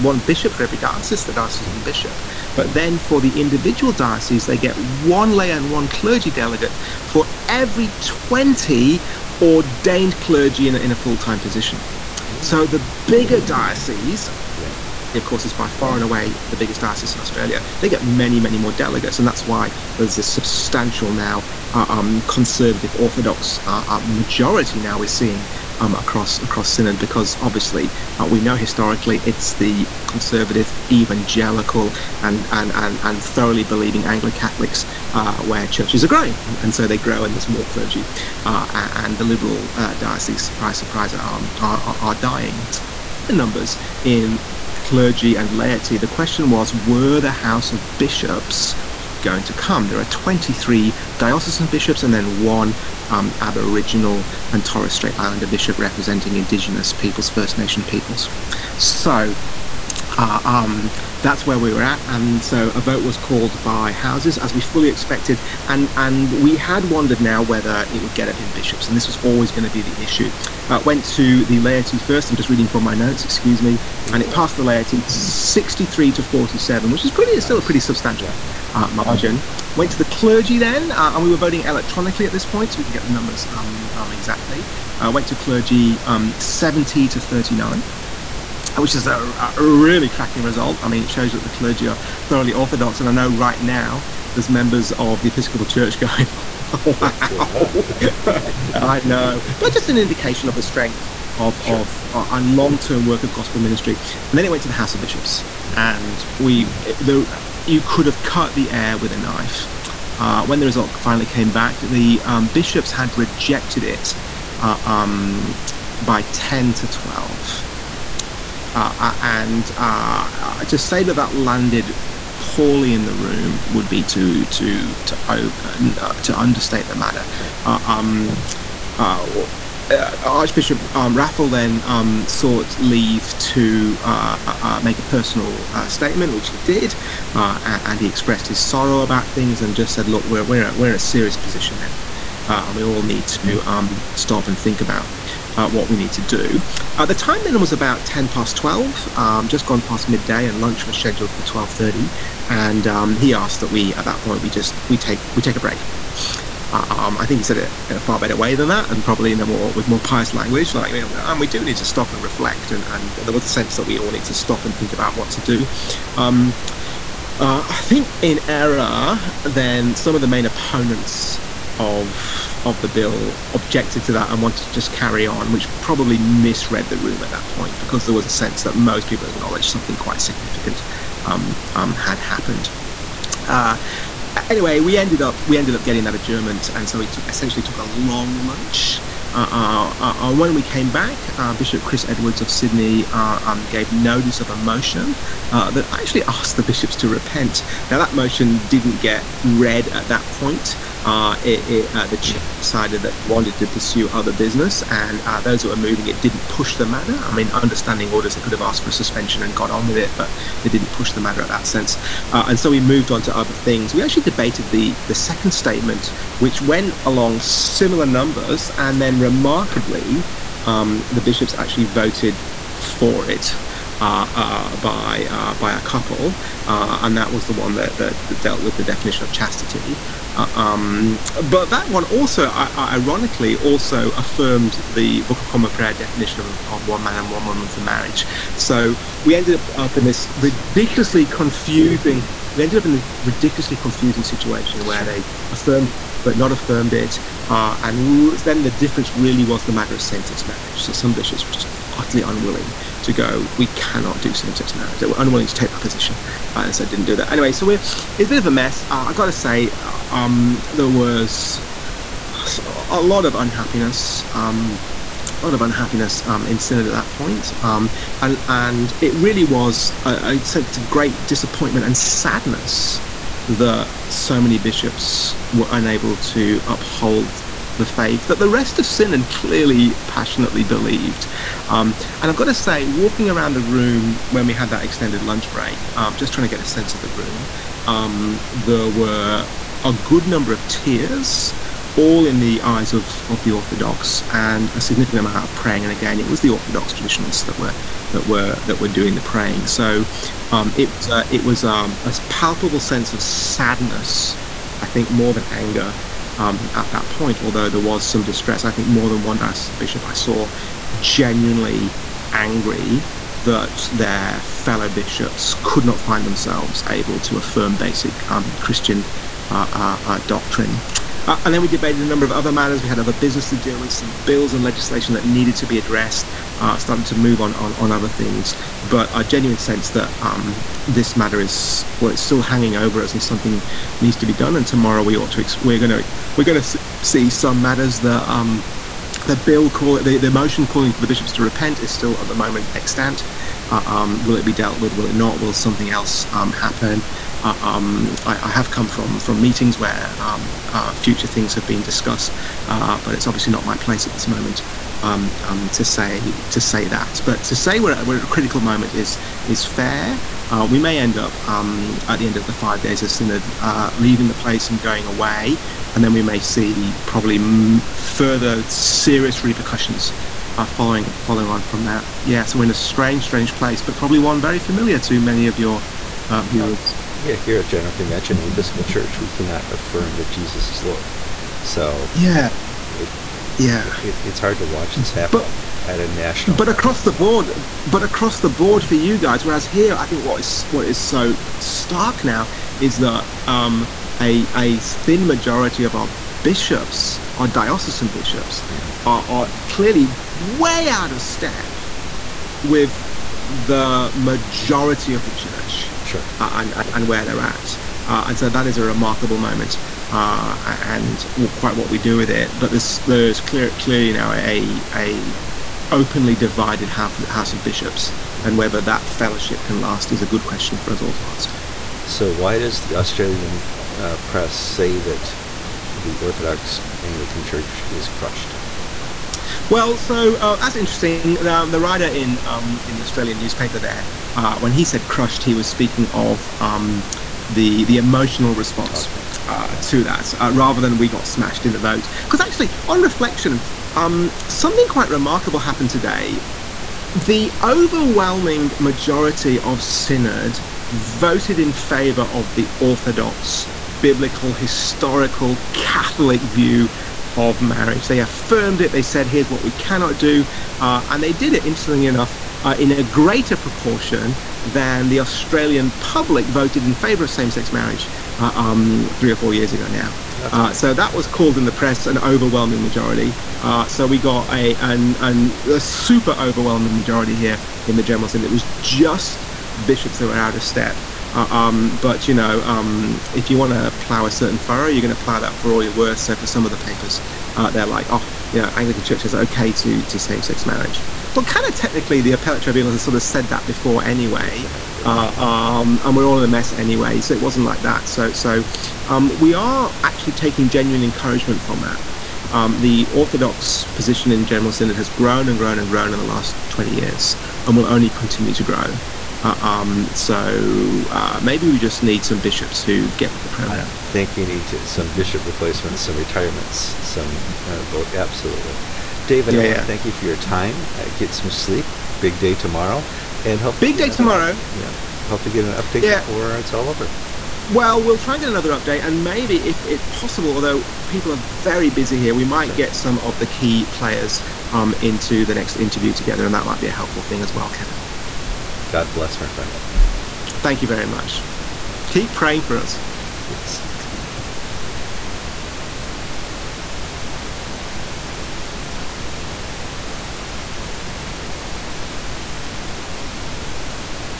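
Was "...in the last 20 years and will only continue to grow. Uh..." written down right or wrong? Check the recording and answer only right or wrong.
right.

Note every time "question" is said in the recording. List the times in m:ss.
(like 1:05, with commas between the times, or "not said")
0:46, 7:00.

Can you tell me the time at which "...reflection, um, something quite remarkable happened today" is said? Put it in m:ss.
7:23.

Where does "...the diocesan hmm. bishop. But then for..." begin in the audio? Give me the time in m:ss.
0:01.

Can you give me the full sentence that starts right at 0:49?
There are 23 diocesan bishops and then one um, Aboriginal and Torres Strait Islander bishop representing Indigenous peoples, First Nation peoples.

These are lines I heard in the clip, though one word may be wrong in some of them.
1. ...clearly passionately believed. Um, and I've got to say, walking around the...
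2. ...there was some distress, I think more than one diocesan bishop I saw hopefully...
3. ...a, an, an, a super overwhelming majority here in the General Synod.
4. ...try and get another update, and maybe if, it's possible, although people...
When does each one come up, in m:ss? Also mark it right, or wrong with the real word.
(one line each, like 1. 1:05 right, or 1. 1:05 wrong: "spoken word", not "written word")
1. 4:39 right
2. 5:07 wrong: "genuinely", not "hopefully"
3. 7:54 right
4. 8:48 right.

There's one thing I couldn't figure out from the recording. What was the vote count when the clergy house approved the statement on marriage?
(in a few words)
70 to 39.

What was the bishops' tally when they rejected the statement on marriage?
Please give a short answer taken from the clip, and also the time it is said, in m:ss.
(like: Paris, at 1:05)
10 to 12, at 1:56.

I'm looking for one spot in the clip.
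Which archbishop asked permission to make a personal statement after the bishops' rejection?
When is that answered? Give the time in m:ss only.
2:11.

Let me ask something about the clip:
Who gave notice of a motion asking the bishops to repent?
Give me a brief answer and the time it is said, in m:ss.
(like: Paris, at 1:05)
Chris Edwards, at 3:11.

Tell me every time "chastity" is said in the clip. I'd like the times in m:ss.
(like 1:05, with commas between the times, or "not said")
3:49.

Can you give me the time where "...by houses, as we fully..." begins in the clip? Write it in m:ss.
1:03.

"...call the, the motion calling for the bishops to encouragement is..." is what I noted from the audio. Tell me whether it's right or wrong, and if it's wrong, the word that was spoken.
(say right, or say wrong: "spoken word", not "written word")
wrong: "repent", not "encouragement".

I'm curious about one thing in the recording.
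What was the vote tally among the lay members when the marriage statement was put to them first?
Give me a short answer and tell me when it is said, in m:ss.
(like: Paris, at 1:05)
63 to 47, at 1:15.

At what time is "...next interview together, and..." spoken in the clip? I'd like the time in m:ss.
8:55.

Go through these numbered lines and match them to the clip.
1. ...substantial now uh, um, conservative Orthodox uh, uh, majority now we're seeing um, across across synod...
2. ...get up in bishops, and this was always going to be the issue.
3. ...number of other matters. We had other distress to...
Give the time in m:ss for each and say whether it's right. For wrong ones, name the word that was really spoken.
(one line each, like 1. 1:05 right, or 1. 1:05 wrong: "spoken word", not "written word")
1. 0:20 right
2. 1:08 right
3. 5:22 wrong: "business", not "distress".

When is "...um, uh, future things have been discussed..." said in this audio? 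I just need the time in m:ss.
5:50.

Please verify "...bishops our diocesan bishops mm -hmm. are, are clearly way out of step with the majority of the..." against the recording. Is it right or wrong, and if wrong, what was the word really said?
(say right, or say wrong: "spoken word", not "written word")
right.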